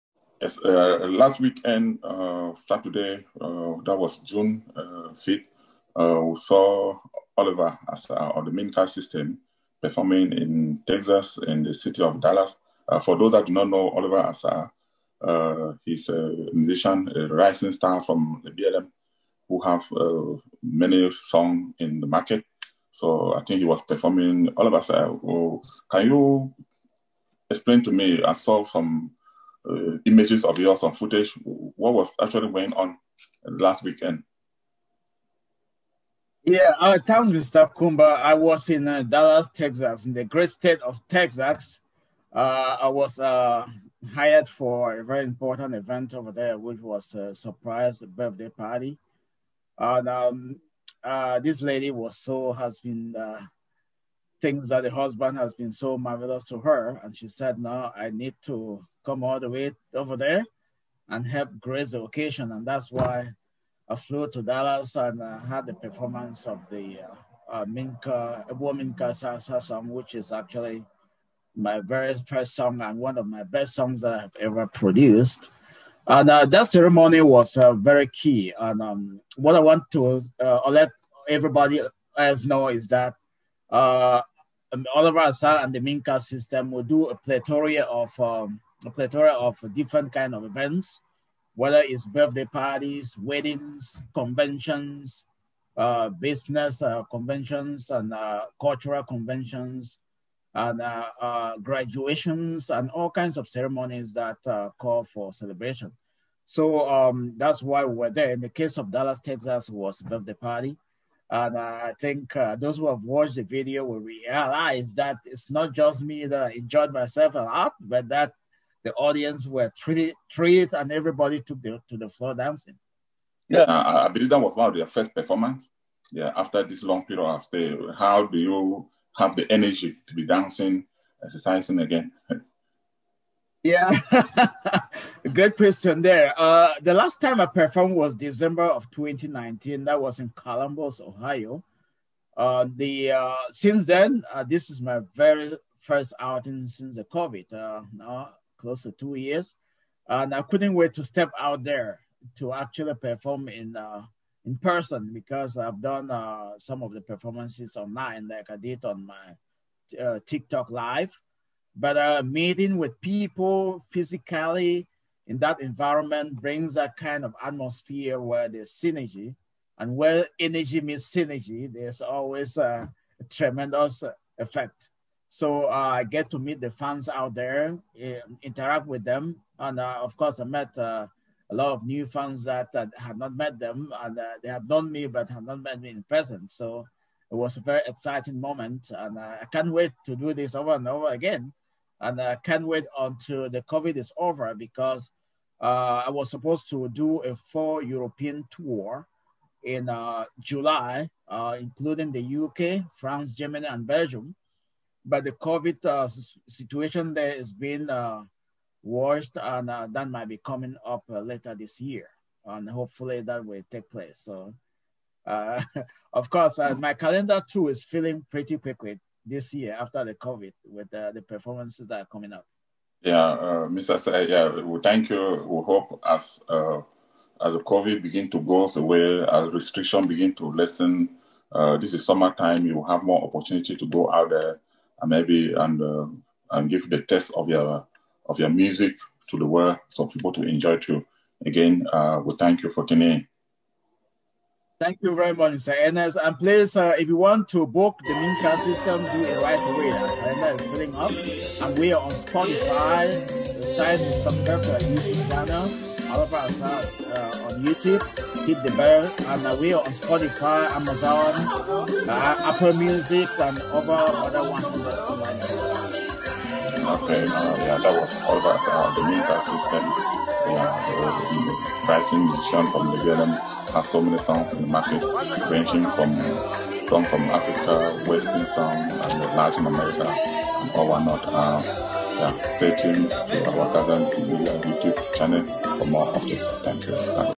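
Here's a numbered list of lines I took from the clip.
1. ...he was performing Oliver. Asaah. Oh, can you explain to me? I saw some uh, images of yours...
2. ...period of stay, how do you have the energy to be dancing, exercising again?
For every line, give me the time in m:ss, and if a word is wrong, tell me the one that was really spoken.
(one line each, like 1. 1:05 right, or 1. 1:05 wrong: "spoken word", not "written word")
1. 0:23 right
2. 2:07 right.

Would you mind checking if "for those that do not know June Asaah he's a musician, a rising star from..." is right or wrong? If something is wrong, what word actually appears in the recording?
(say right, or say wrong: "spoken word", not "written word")
wrong: "Oliver", not "June".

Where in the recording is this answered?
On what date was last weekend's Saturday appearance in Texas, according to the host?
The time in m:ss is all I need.
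0:04.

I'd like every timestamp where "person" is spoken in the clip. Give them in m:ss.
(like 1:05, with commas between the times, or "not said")
2:34, 3:06.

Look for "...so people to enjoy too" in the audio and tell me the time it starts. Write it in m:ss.
3:59.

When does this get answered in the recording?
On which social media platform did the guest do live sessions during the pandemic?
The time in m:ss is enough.
2:40.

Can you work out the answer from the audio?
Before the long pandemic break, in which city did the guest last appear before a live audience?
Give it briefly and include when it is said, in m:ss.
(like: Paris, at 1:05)
Columbus, Ohio, at 2:20.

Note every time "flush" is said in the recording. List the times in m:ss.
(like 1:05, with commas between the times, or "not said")
not said.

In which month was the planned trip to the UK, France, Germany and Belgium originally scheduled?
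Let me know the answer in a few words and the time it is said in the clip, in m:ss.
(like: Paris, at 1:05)
July, at 3:20.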